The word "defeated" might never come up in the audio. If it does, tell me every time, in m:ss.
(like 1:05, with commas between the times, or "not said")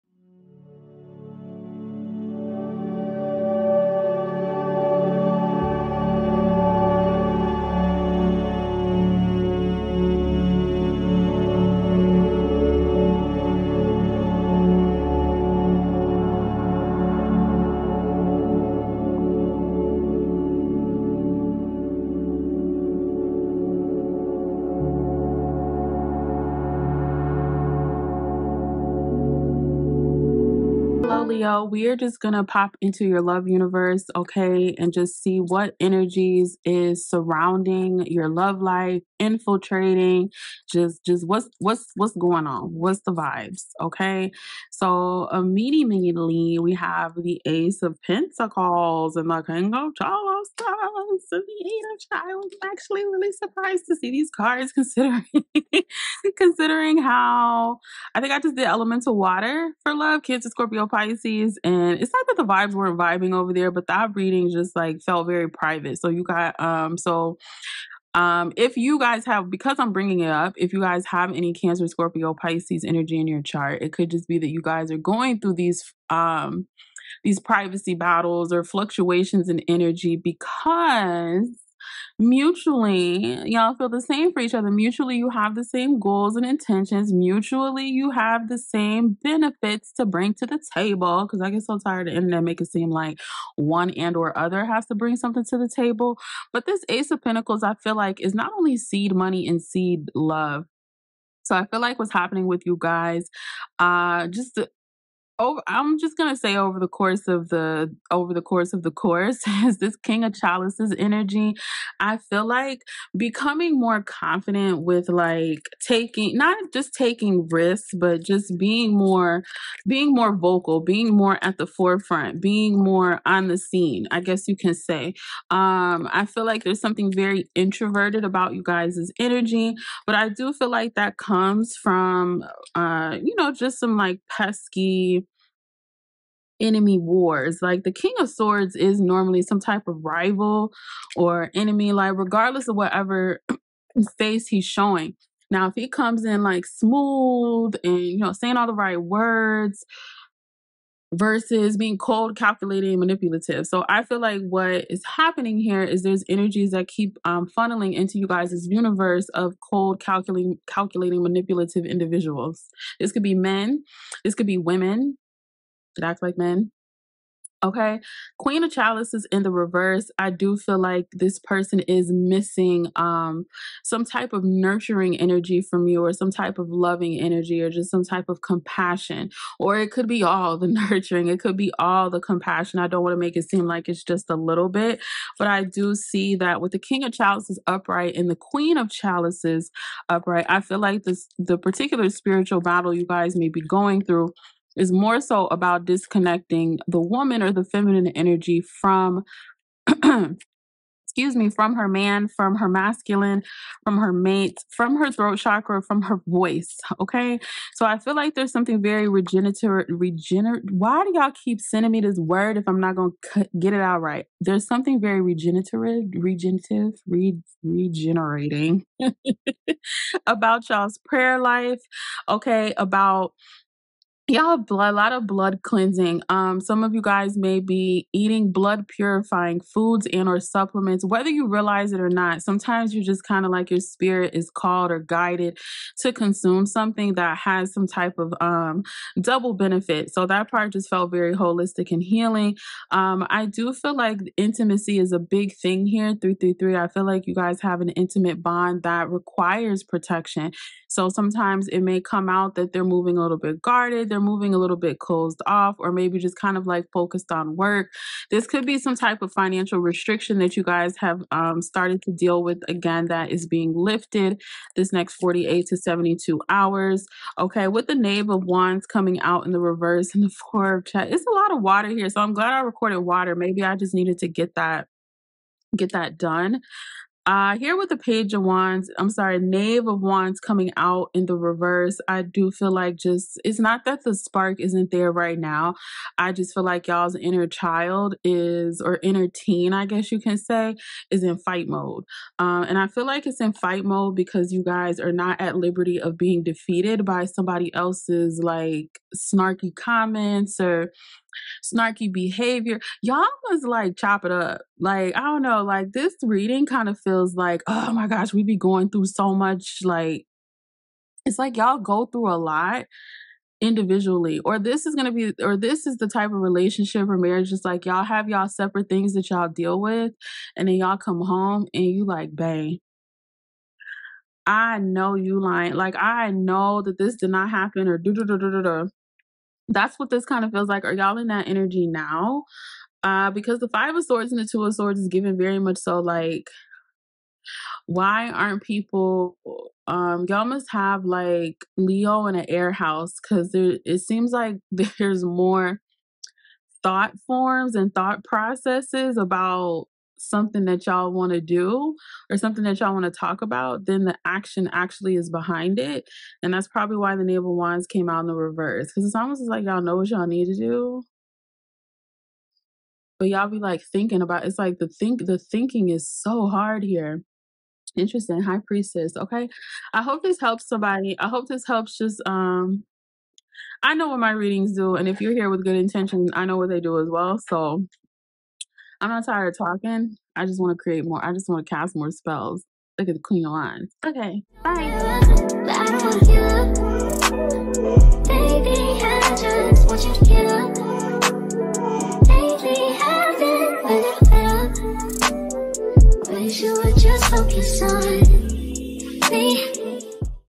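4:56.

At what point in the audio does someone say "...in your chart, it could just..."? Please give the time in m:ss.
1:13.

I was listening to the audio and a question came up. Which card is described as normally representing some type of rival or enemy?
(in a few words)
King of Swords.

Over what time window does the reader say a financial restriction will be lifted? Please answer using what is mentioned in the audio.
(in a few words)
48 to 72 hours.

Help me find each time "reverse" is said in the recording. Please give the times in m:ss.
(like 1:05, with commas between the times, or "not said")
2:49, 4:29, 4:41, 5:58.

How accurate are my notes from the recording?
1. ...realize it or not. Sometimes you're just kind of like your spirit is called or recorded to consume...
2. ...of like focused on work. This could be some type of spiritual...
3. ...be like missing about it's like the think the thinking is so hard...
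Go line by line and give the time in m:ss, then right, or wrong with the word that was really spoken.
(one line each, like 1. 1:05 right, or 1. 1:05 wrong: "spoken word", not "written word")
1. 3:51 wrong: "guided", not "recorded"
2. 4:16 wrong: "financial", not "spiritual"
3. 6:03 wrong: "thinking", not "missing".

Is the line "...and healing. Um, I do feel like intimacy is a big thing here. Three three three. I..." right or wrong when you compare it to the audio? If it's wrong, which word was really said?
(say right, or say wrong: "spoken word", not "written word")
right.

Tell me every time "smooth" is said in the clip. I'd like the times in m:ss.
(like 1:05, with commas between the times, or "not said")
2:26.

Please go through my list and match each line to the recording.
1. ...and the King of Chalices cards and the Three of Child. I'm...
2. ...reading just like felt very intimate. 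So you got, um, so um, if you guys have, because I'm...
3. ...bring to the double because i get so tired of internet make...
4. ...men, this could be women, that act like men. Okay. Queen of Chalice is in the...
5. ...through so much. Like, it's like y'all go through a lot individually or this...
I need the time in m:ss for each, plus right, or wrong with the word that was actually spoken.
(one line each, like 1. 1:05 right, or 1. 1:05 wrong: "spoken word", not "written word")
1. 0:49 wrong: "Eight", not "Three"
2. 1:04 wrong: "private", not "intimate"
3. 1:30 wrong: "table", not "double"
4. 2:43 right
5. 5:08 right.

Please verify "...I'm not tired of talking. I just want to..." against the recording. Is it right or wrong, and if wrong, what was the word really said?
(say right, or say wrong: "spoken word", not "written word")
right.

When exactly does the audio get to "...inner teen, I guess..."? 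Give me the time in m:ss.
4:49.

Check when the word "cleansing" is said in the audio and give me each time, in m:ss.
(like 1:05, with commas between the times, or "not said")
3:45.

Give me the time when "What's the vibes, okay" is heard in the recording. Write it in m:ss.
0:42.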